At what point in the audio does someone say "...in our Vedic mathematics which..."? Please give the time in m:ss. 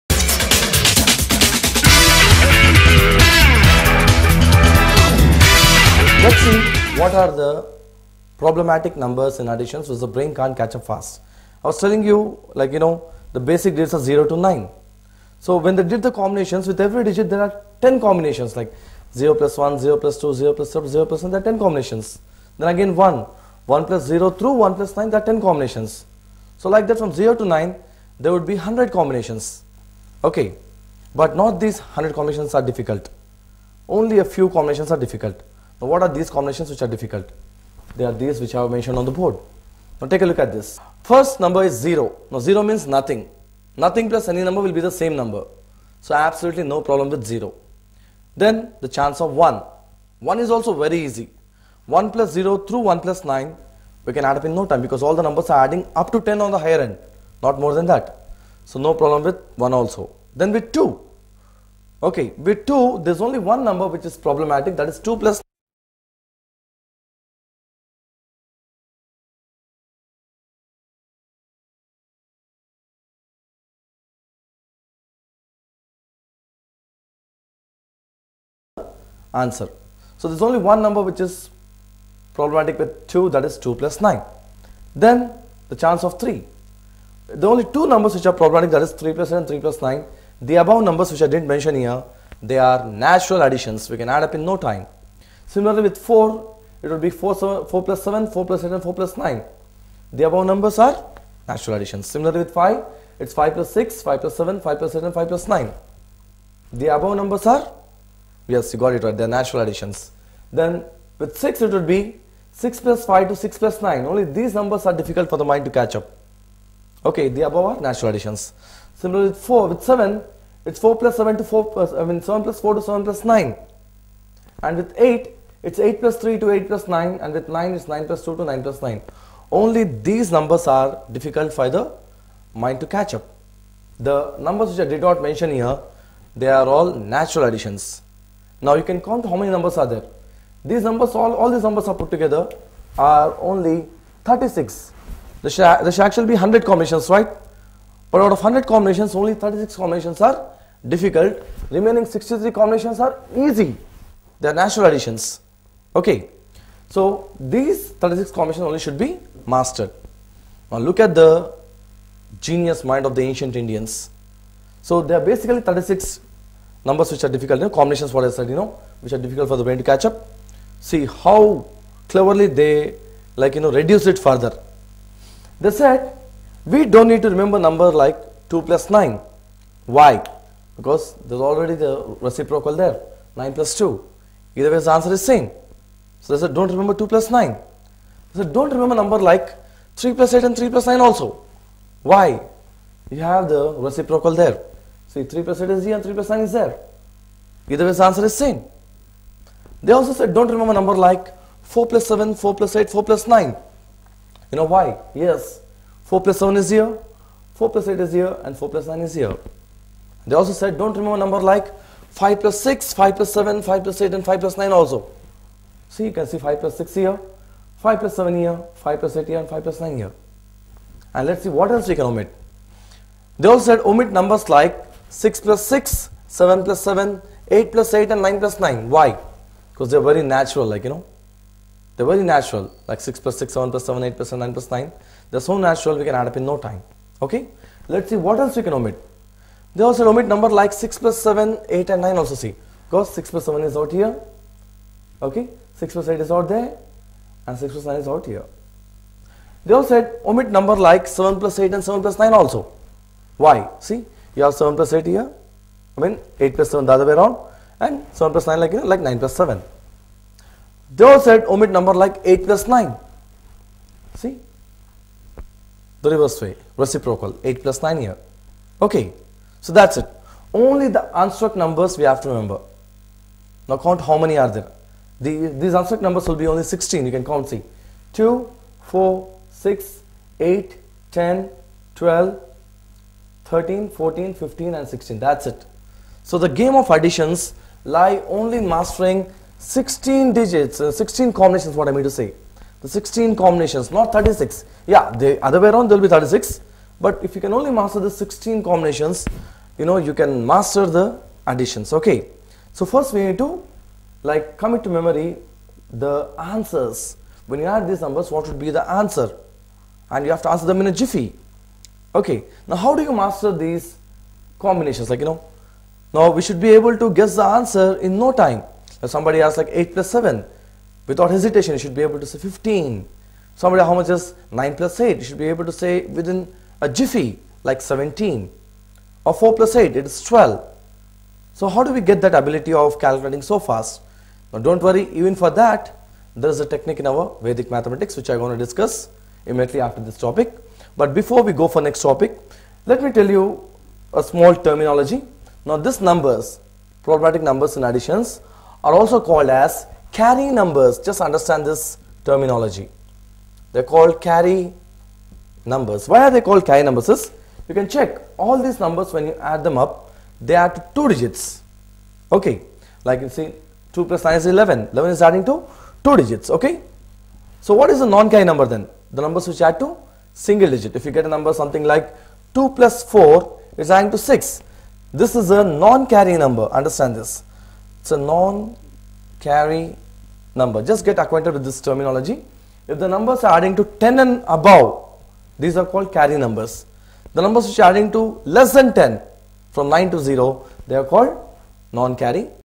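5:36.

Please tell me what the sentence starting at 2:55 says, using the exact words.
They said, we don't need to remember number like 2 plus 9.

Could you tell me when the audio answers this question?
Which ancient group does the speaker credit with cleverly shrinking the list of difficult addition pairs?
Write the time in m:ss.
2:43.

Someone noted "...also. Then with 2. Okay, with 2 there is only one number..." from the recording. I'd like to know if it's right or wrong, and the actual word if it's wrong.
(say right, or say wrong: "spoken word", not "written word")
right.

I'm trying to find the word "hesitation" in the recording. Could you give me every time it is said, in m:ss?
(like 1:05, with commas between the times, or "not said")
5:21.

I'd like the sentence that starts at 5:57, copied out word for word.
Is you can check all these numbers when you add them up, they are to two digits.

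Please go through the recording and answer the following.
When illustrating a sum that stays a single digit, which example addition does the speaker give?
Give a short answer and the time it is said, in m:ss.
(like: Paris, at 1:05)
2 plus 4, at 6:12.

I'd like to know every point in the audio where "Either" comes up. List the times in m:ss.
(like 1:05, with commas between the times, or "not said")
3:04, 3:17.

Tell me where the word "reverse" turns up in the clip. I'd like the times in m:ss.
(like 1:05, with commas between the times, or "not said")
4:26.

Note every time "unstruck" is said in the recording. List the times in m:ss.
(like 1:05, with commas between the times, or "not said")
4:31, 4:35.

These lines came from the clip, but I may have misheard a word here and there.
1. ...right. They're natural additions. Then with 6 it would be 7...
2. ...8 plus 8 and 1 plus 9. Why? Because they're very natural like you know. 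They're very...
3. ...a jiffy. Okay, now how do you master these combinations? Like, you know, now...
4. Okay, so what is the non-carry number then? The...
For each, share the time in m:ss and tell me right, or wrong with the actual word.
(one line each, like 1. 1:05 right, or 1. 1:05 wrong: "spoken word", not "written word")
1. 1:49 wrong: "6", not "7"
2. 3:47 wrong: "9", not "1"
3. 5:10 right
4. 6:06 right.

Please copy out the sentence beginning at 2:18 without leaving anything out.
Now you can count how many numbers are there.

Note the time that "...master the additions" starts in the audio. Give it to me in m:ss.
5:00.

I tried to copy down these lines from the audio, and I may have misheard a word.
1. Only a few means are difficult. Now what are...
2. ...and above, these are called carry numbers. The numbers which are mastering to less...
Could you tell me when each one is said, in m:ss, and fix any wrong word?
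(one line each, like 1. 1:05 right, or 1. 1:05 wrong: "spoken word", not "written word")
1. 0:33 wrong: "combinations", not "means"
2. 6:24 wrong: "adding", not "mastering".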